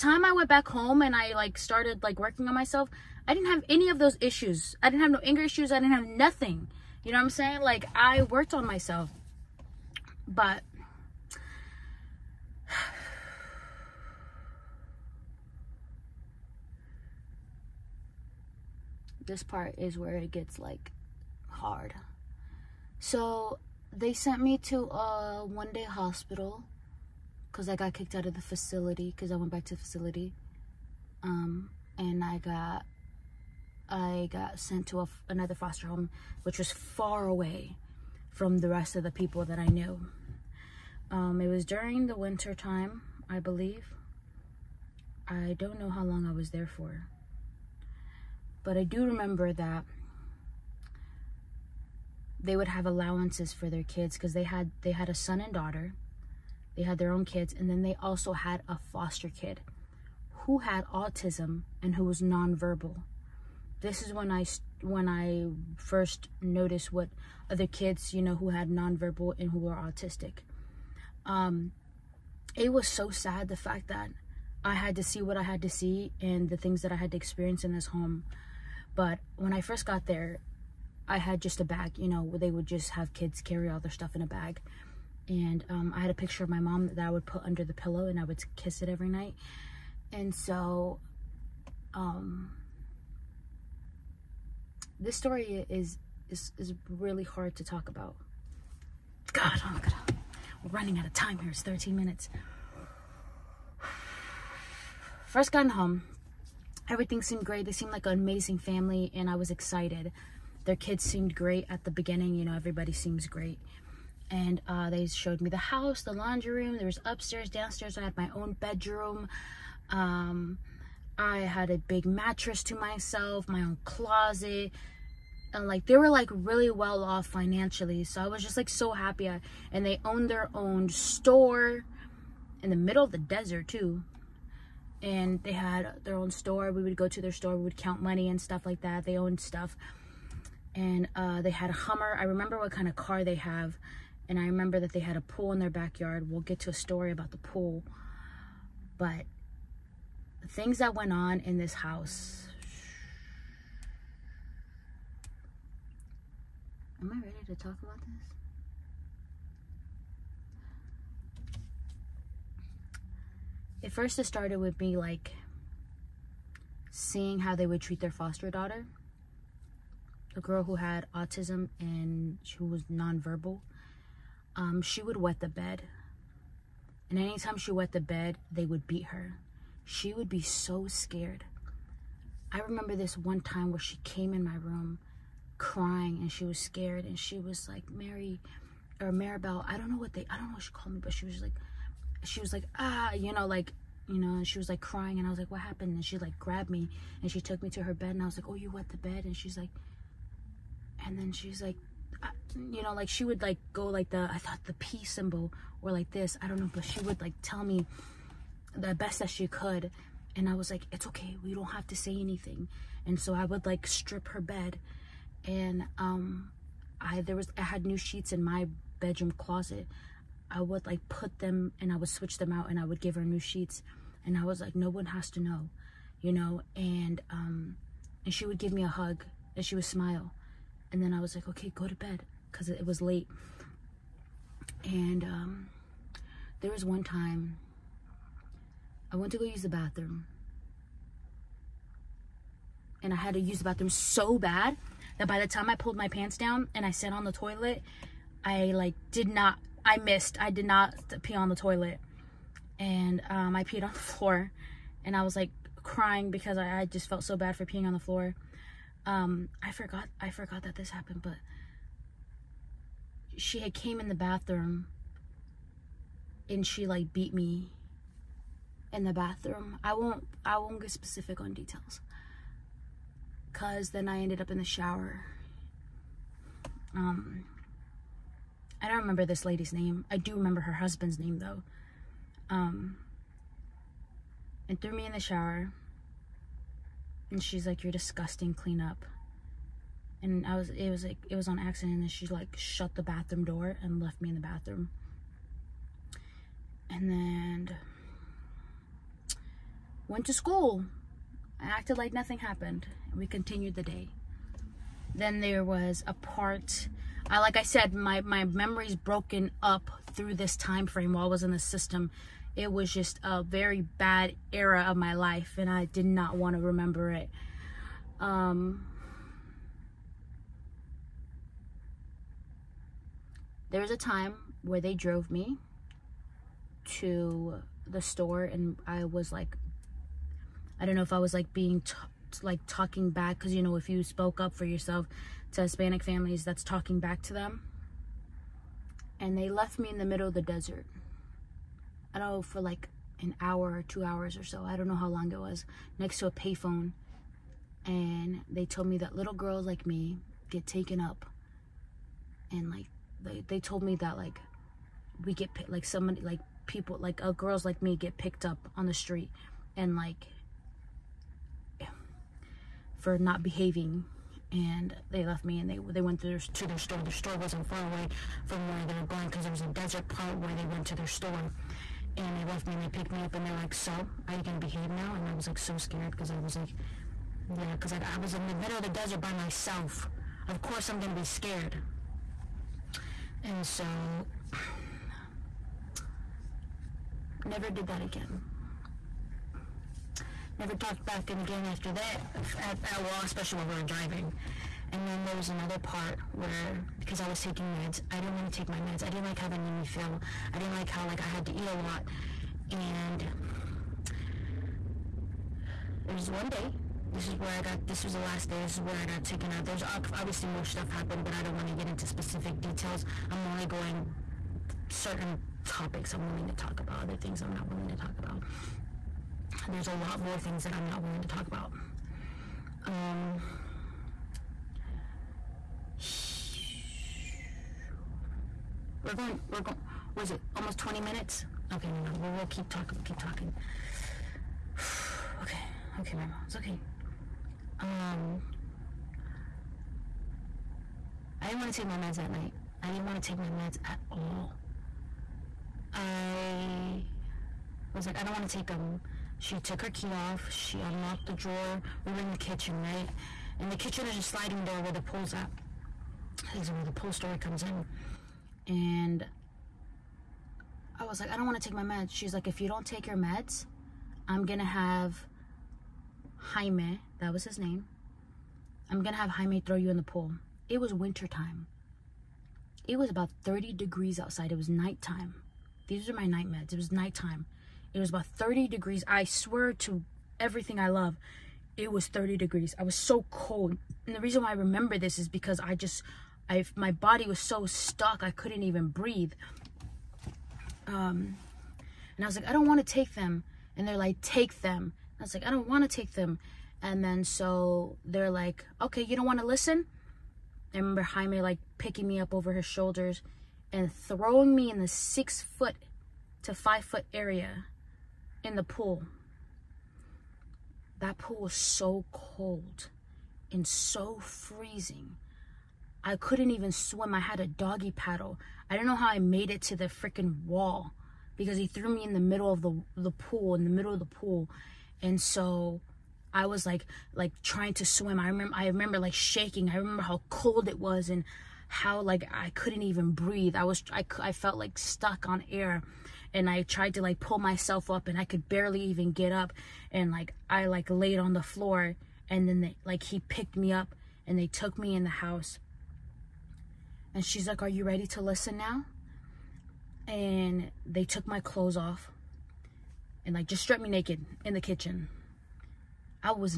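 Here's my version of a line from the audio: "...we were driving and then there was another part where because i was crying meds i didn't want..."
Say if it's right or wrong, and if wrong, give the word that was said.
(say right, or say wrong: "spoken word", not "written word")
wrong: "taking", not "crying".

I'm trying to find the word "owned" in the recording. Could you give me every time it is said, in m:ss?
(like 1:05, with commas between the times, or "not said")
2:10, 2:19.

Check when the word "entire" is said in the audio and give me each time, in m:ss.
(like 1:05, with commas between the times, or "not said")
not said.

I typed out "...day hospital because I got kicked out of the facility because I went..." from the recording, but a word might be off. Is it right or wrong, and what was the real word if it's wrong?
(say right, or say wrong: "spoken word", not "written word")
right.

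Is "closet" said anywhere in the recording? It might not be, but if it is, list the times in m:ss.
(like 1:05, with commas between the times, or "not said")
2:03, 3:39.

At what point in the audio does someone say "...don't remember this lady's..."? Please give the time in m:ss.
4:38.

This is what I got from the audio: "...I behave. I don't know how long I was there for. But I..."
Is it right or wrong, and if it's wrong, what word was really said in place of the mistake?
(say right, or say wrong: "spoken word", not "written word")
wrong: "believe", not "behave".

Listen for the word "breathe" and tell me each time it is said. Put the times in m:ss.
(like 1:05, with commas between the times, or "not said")
8:08, 8:53.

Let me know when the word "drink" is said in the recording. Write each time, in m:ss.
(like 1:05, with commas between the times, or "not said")
not said.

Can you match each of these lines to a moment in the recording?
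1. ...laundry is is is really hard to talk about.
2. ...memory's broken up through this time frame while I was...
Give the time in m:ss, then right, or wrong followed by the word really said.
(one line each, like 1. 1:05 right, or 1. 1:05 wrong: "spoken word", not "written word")
1. 1:35 wrong: "story", not "laundry"
2. 5:08 right.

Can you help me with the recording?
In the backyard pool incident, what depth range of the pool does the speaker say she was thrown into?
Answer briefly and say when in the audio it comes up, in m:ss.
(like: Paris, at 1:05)
Six foot to five foot, at 8:24.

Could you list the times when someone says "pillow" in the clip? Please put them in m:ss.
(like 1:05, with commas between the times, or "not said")
1:27.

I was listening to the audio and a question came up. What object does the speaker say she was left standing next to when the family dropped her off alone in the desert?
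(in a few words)
A payphone.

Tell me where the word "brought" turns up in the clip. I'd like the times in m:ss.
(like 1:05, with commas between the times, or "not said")
not said.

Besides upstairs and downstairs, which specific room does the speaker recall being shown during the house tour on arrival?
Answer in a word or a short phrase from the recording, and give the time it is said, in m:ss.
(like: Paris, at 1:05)
The laundry room, at 1:56.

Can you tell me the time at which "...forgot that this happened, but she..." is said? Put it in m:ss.
4:20.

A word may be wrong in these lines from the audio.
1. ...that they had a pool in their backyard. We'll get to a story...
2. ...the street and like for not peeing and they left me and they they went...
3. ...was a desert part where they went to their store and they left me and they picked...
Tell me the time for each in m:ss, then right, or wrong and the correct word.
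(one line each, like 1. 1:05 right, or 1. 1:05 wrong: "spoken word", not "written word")
1. 2:24 right
2. 5:58 wrong: "behaving", not "peeing"
3. 6:09 right.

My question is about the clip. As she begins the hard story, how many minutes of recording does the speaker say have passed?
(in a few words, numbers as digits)
13.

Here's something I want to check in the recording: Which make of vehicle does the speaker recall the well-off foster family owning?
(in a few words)
Hummer.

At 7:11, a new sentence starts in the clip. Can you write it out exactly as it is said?
Okay, no, no, we'll, we'll keep talking, we'll keep talking.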